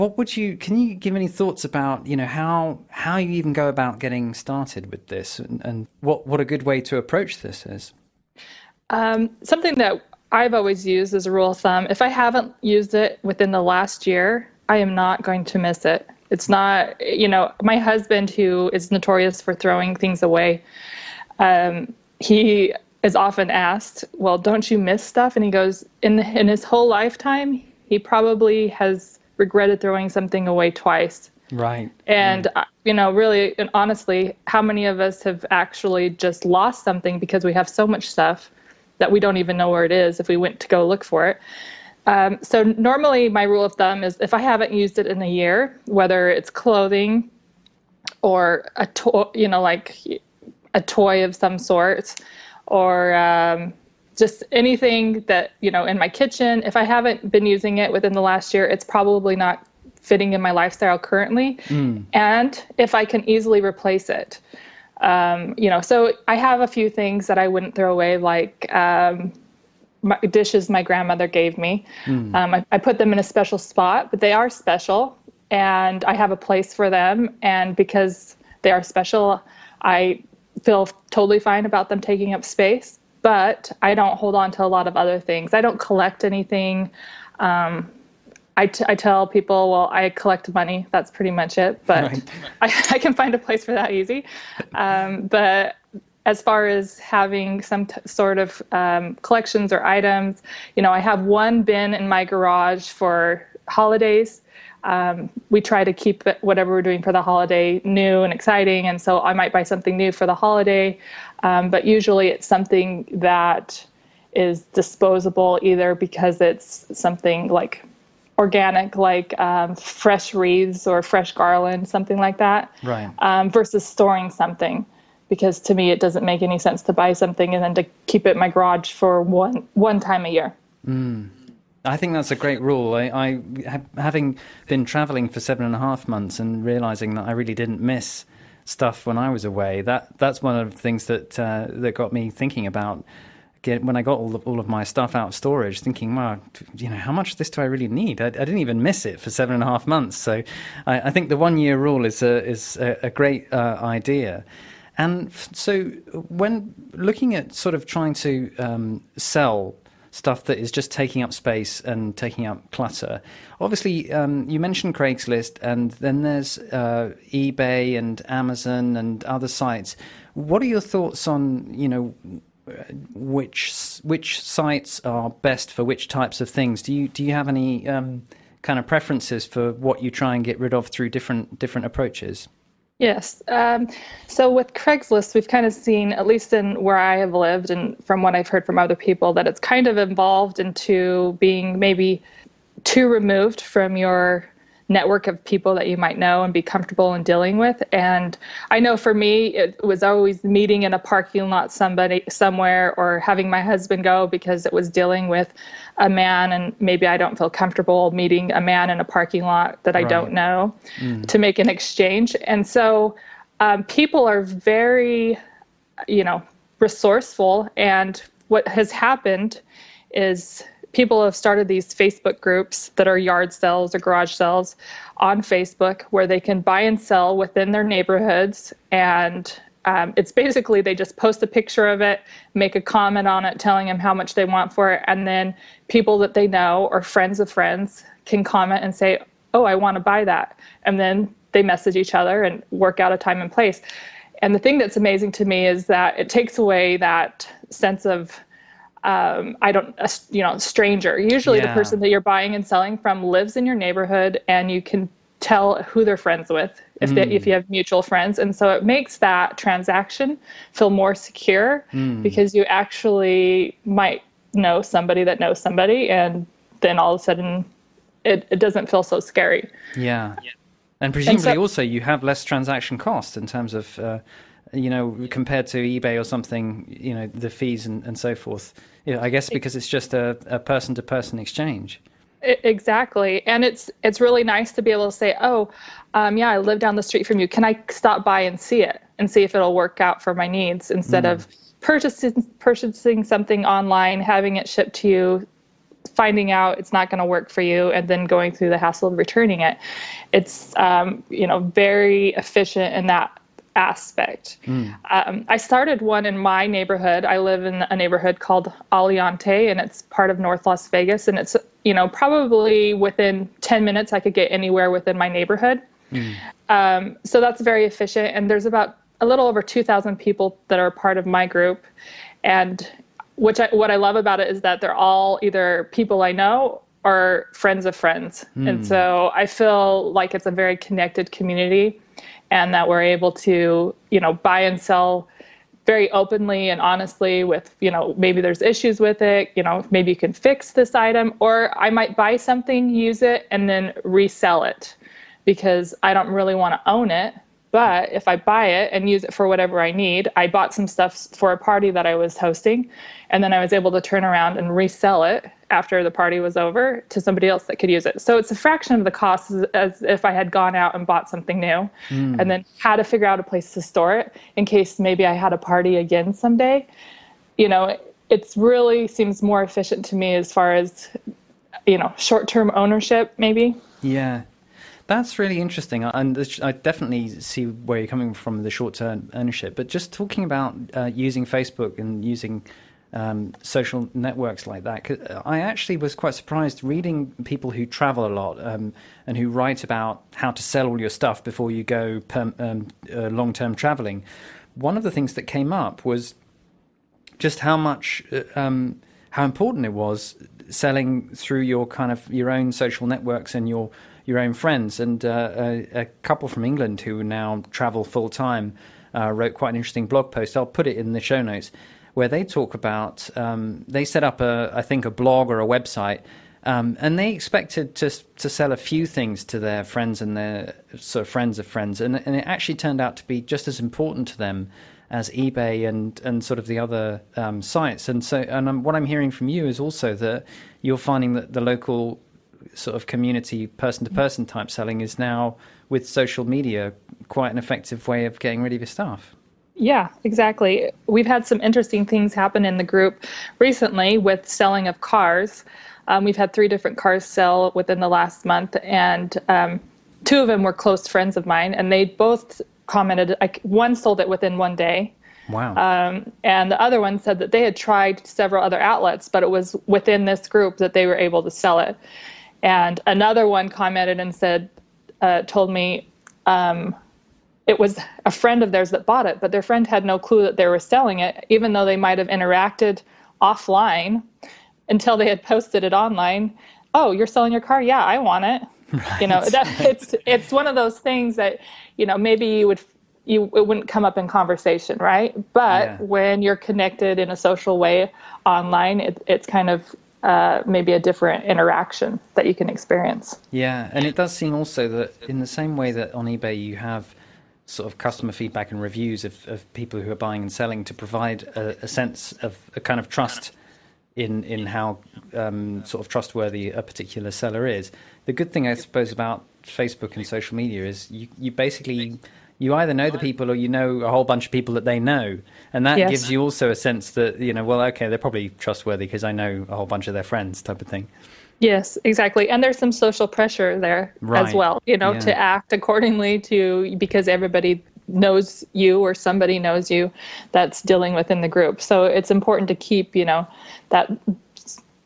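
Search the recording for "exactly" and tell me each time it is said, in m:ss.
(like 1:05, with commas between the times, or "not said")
4:42, 7:20, 8:42.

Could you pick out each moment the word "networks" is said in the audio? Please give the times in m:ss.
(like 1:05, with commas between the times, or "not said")
3:14, 6:24, 6:43.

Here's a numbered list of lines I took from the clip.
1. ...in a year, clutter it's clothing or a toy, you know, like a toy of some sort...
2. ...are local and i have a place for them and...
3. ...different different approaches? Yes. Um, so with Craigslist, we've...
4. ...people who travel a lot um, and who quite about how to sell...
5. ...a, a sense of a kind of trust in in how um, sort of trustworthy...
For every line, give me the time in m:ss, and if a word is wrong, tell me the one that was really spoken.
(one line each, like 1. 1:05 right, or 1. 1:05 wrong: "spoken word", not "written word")
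1. 0:45 wrong: "whether", not "clutter"
2. 1:14 wrong: "special", not "local"
3. 3:01 right
4. 6:27 wrong: "write", not "quite"
5. 8:21 right.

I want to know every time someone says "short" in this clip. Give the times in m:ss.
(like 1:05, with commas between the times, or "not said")
6:12, 6:18.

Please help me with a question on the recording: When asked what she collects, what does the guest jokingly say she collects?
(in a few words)
money.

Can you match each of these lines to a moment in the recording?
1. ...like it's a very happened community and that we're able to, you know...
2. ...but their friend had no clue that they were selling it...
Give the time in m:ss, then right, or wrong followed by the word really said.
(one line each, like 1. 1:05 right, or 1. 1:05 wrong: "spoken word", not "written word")
1. 5:30 wrong: "connected", not "happened"
2. 7:49 right.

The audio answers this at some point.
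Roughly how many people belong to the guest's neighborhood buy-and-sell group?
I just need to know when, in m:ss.
5:19.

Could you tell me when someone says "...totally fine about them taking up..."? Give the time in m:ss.
1:21.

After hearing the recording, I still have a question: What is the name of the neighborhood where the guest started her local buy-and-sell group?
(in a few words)
Aliante.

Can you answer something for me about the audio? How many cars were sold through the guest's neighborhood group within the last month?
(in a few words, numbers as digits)
3.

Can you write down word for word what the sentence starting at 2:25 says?
Thinking, well, you know, how much of this do I really need?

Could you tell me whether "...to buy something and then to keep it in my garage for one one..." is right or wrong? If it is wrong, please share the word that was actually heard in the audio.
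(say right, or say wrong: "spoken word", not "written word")
right.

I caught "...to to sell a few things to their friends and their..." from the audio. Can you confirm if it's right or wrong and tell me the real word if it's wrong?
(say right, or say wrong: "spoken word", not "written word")
right.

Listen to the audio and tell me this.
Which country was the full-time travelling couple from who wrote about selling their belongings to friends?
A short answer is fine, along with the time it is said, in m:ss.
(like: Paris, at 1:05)
England, at 6:46.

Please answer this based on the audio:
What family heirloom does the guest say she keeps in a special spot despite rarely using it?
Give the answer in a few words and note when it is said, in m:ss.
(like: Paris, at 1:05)
dishes, at 1:10.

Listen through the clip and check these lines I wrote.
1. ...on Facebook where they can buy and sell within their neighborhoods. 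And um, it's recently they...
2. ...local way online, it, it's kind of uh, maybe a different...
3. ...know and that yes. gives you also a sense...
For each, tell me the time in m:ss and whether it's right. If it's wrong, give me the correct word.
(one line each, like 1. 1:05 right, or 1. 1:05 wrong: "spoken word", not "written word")
1. 3:45 wrong: "basically", not "recently"
2. 8:07 wrong: "social", not "local"
3. 8:35 right.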